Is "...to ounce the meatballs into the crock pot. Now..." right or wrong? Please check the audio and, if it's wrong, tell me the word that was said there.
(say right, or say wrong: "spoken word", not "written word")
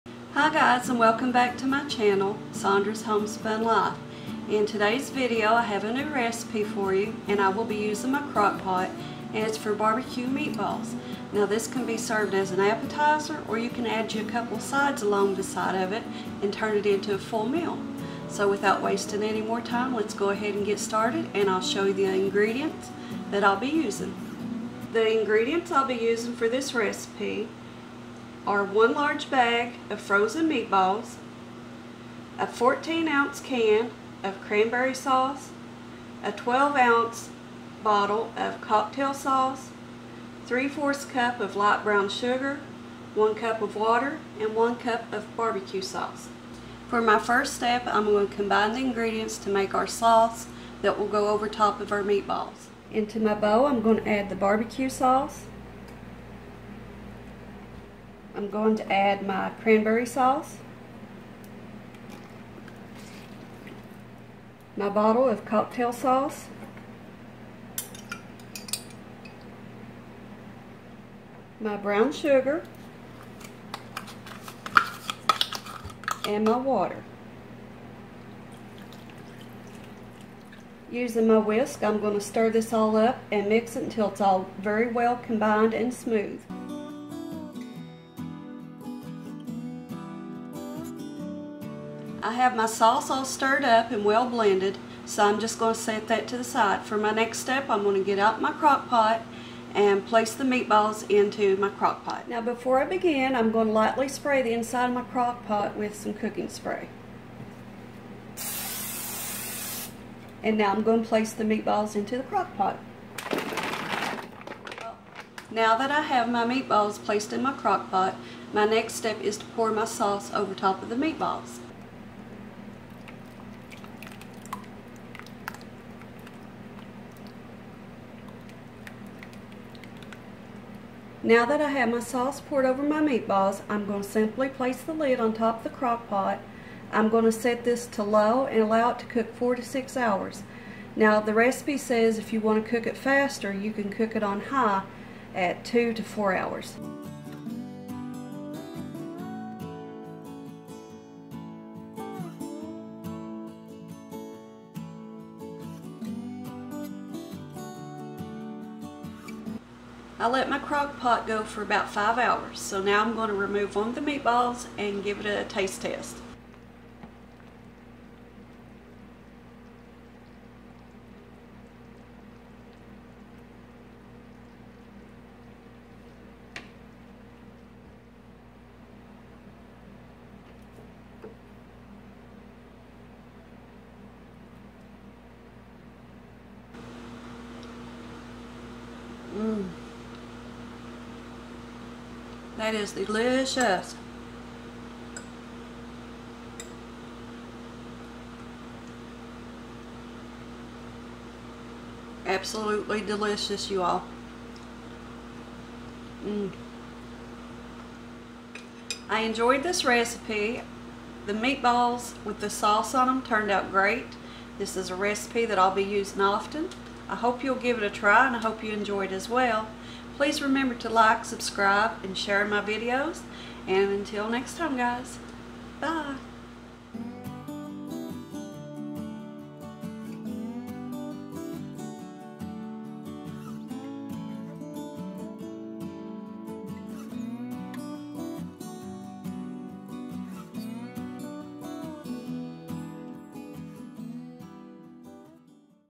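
wrong: "place", not "ounce".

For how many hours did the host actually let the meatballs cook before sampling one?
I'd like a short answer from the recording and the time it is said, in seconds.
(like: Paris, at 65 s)
5 hours, at 161 s.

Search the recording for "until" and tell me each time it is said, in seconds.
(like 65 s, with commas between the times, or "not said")
83 s, 223 s.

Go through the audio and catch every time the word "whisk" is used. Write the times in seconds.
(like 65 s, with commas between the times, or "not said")
81 s.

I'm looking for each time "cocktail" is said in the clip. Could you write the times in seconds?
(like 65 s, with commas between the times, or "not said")
38 s, 65 s.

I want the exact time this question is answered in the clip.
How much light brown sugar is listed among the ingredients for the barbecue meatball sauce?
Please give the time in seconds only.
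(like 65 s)
40 s.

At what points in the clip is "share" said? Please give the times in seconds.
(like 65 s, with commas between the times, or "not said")
222 s.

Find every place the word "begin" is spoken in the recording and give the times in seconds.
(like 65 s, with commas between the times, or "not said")
102 s.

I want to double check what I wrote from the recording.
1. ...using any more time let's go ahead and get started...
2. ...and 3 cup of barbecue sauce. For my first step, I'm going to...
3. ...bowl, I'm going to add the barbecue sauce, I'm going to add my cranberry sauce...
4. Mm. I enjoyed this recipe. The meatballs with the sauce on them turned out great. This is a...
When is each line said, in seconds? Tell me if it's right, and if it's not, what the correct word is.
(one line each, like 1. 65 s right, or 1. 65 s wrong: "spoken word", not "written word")
1. 18 s wrong: "wasting", not "using"
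2. 44 s wrong: "1", not "3"
3. 53 s right
4. 206 s right.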